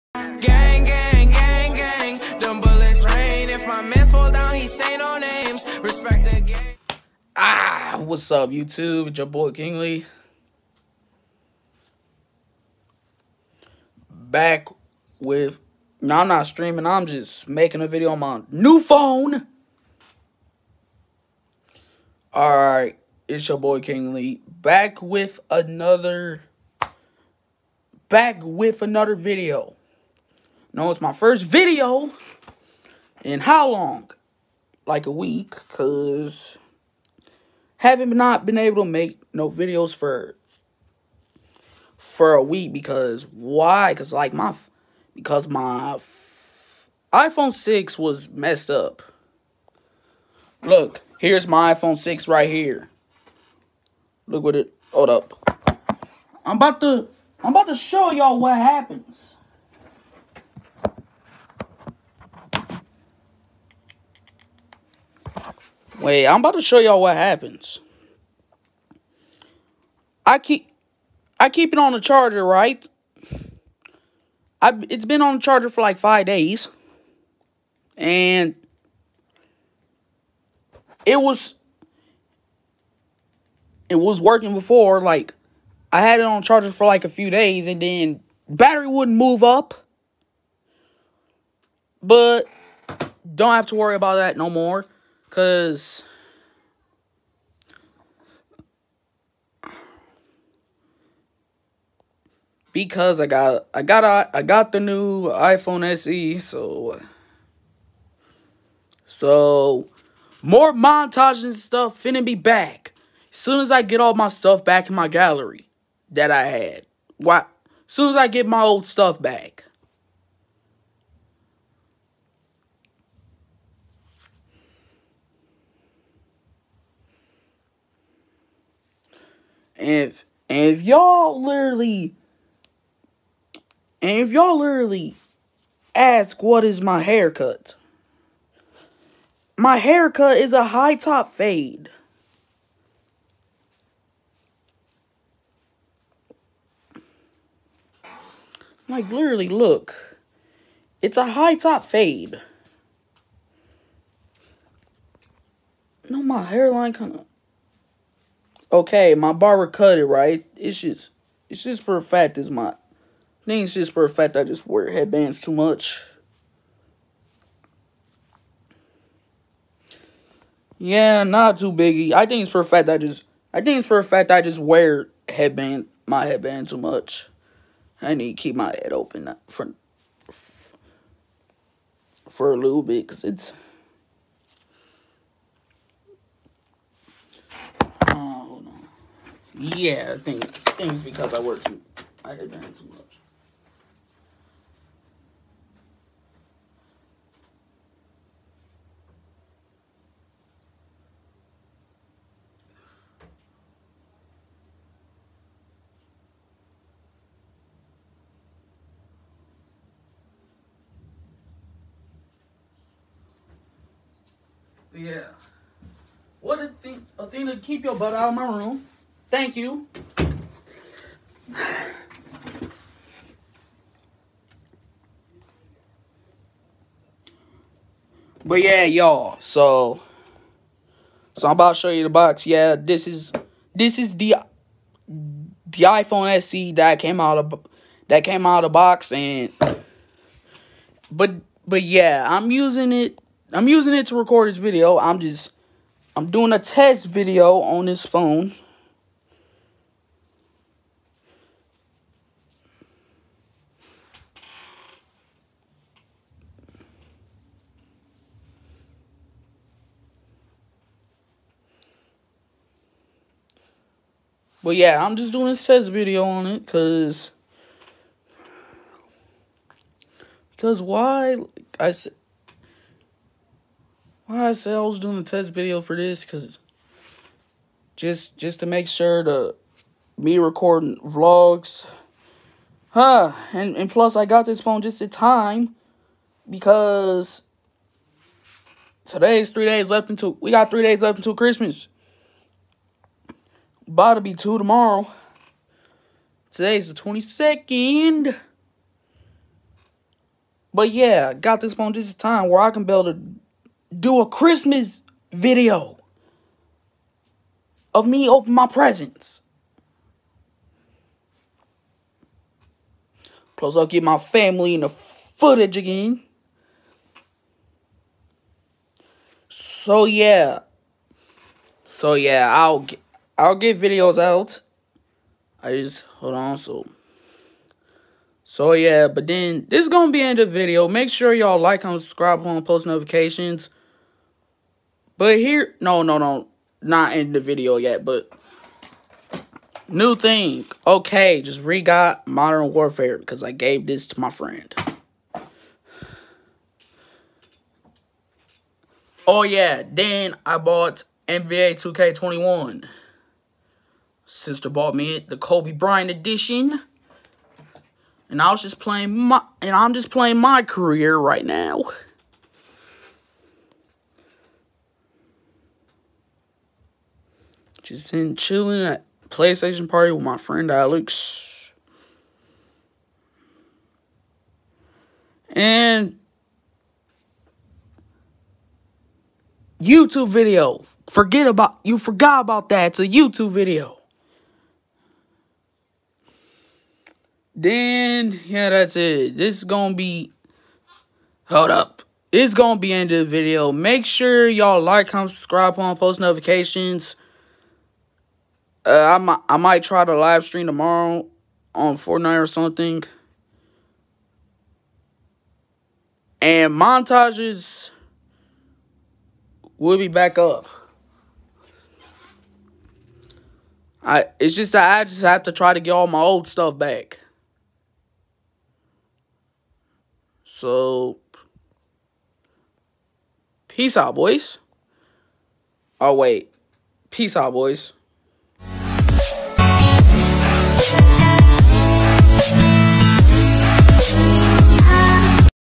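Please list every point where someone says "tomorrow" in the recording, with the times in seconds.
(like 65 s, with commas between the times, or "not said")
294 s, 400 s.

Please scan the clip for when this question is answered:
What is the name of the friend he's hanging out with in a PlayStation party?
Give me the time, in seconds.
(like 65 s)
370 s.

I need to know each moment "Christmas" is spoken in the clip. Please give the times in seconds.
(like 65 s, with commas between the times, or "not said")
291 s, 304 s.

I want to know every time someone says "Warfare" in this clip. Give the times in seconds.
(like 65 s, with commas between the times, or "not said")
342 s.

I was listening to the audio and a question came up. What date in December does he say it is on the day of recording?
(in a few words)
22nd.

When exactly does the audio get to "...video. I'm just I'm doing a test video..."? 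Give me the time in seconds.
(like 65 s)
244 s.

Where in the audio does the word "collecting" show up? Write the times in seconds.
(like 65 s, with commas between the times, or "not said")
not said.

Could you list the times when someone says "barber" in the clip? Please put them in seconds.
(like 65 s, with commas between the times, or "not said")
159 s.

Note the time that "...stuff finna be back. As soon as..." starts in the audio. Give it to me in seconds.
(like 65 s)
111 s.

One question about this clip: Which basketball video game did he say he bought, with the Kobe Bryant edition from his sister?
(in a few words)
NBA 2K21.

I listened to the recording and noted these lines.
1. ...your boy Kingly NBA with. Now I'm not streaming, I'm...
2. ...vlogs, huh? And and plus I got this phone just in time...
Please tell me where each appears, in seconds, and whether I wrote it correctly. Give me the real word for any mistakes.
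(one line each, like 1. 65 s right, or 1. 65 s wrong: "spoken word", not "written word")
1. 9 s wrong: "Back", not "NBA"
2. 280 s right.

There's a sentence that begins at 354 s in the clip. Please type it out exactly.
Sister bought me the Kobe Bryant edition.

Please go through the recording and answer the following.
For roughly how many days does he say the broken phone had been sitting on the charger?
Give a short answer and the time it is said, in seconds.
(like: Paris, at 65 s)
5 days, at 75 s.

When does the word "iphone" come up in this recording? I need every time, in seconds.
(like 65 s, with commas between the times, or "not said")
47 s, 51 s, 105 s, 235 s.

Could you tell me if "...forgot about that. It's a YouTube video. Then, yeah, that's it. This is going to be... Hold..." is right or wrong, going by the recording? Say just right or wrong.
right.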